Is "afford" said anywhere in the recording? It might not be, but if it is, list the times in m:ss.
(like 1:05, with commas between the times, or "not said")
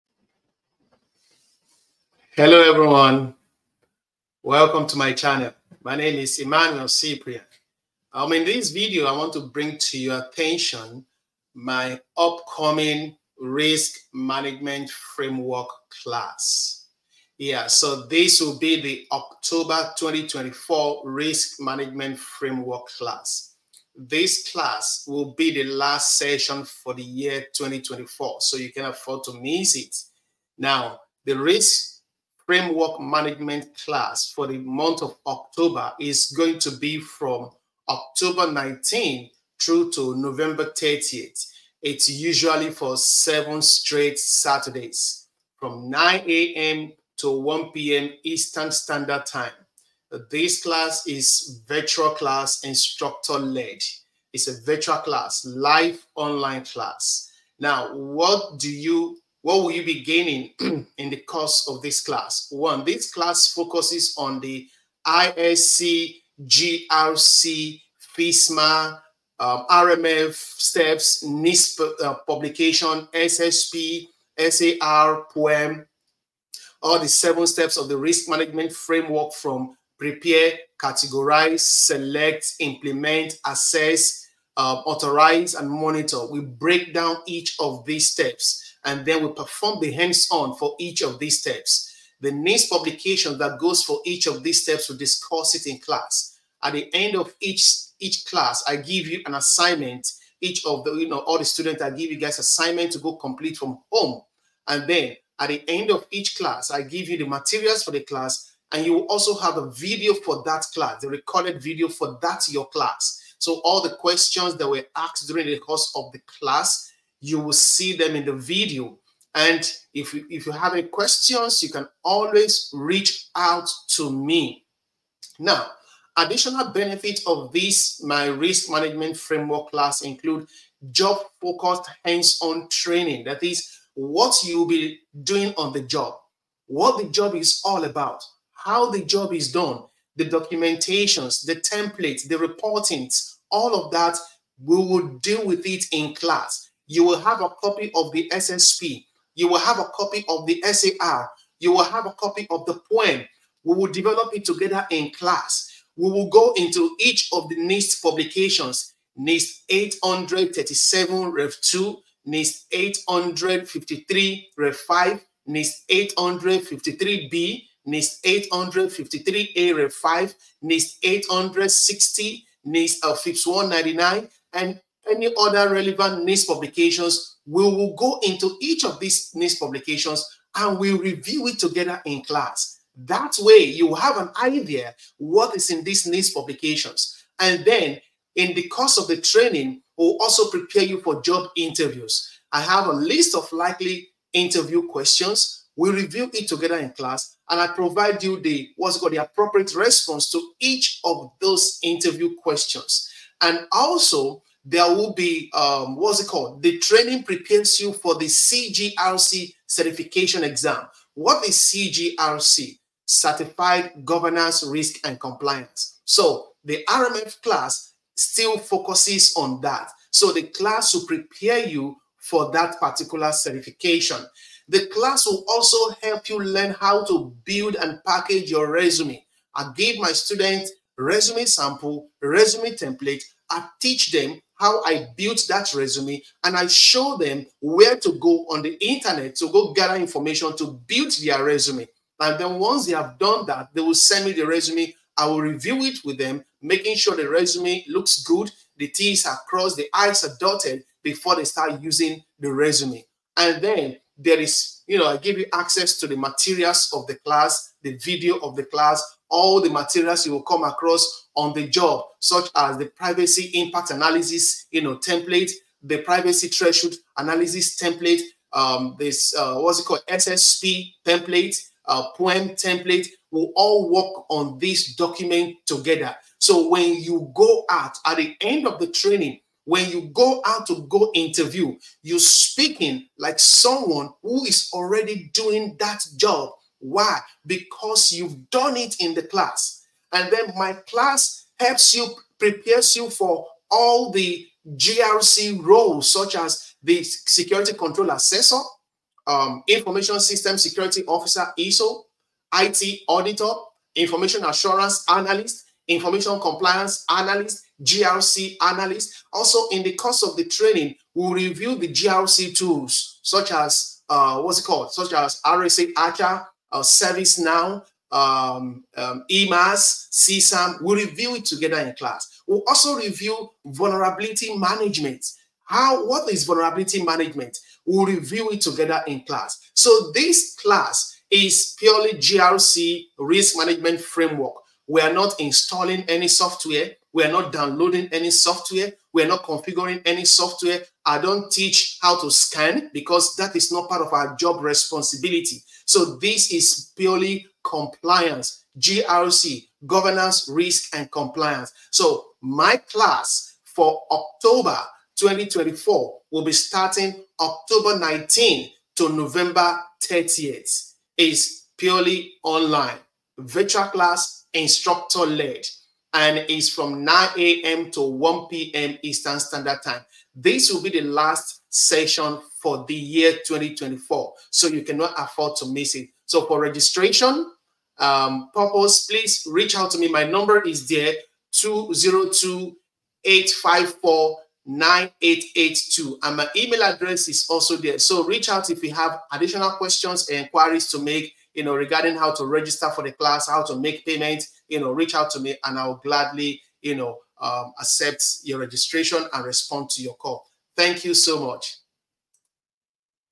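0:28, 6:15.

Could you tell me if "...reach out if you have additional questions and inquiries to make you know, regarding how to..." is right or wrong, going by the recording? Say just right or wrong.
right.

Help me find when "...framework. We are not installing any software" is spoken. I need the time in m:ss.
5:34.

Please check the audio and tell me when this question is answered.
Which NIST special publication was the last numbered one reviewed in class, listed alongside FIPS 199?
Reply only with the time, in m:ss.
2:50.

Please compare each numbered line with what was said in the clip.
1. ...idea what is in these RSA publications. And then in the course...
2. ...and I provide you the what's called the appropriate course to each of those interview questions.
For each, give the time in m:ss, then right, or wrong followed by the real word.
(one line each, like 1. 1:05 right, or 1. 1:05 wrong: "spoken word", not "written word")
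1. 3:04 wrong: "NIST", not "RSA"
2. 3:17 wrong: "response", not "course".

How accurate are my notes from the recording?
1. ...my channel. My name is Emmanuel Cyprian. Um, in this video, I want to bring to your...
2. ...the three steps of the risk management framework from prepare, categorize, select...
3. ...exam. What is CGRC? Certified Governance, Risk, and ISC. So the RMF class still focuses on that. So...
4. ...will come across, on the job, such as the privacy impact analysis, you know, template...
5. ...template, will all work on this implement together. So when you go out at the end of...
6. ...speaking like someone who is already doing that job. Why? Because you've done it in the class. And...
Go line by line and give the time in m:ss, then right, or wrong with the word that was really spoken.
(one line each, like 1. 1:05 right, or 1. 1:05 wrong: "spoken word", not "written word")
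1. 0:04 right
2. 1:16 wrong: "seven", not "three"
3. 3:30 wrong: "Compliance", not "ISC"
4. 4:20 right
5. 4:32 wrong: "document", not "implement"
6. 4:42 right.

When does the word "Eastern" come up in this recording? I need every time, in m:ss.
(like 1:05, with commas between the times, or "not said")
0:48, 6:09.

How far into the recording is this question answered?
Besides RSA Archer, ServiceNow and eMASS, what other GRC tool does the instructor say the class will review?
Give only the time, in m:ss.
5:20.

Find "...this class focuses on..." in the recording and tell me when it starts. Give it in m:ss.
1:02.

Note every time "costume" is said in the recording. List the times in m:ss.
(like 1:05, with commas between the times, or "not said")
not said.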